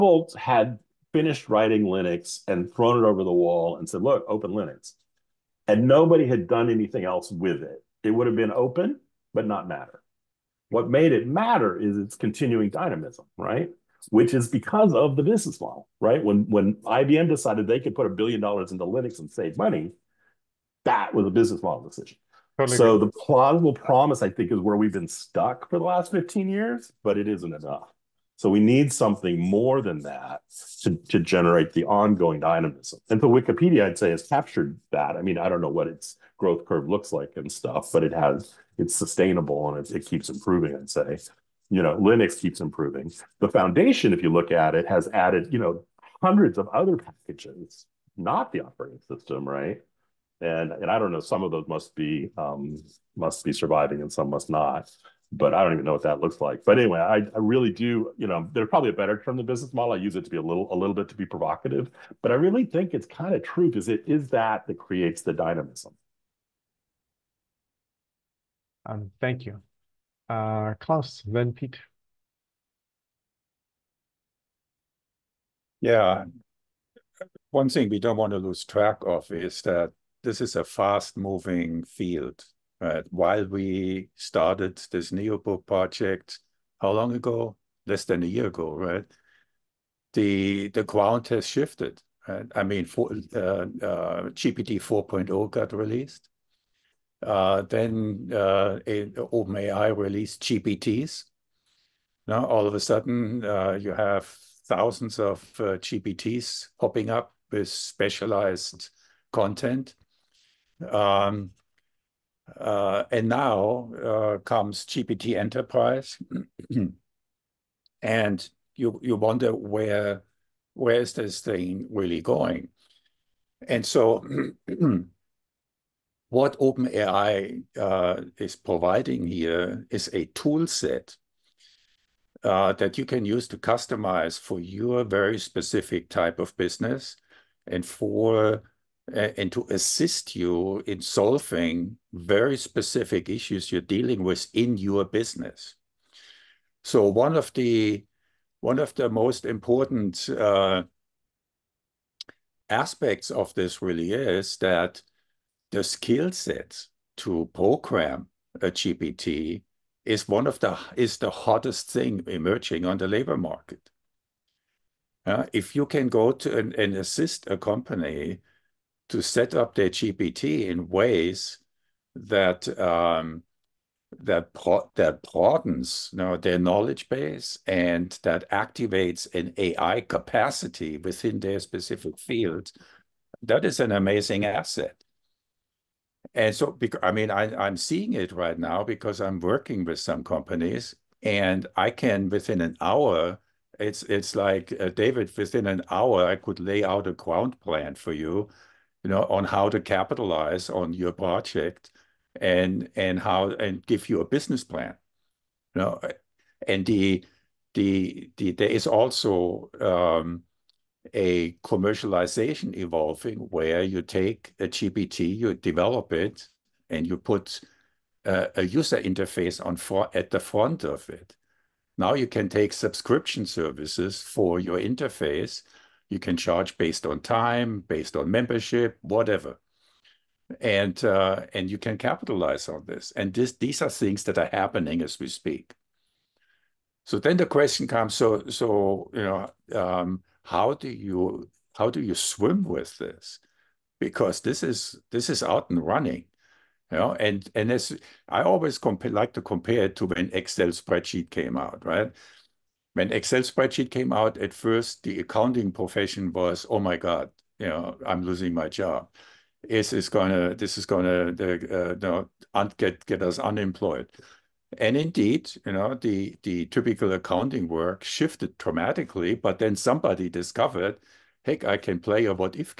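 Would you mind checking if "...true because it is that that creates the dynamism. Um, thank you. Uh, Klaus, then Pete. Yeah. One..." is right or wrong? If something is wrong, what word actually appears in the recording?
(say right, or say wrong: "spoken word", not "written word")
right.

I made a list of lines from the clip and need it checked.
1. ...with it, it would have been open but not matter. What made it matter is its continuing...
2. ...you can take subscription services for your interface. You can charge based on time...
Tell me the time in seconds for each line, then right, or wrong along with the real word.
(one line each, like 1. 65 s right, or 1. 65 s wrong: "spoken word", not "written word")
1. 7 s right
2. 222 s right.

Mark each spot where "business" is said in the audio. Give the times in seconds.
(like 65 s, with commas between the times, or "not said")
15 s, 21 s, 59 s, 136 s, 145 s, 204 s.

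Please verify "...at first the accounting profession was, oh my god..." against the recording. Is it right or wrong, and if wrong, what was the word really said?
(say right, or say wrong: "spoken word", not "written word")
right.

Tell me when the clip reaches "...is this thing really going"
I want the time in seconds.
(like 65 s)
120 s.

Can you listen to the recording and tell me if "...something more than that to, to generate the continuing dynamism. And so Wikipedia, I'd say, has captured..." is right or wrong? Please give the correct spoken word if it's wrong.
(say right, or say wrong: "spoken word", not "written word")
wrong: "ongoing", not "continuing".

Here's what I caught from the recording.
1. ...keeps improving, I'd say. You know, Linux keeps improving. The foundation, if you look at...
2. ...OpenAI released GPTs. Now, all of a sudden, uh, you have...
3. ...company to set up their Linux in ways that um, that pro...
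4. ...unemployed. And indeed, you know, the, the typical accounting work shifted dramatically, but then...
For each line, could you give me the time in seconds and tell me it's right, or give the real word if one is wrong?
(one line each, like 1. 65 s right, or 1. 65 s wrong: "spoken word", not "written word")
1. 40 s right
2. 99 s right
3. 167 s wrong: "GPT", not "Linux"
4. 263 s right.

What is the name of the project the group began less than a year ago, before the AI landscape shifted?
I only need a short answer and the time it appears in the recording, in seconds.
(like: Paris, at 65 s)
Neobook, at 85 s.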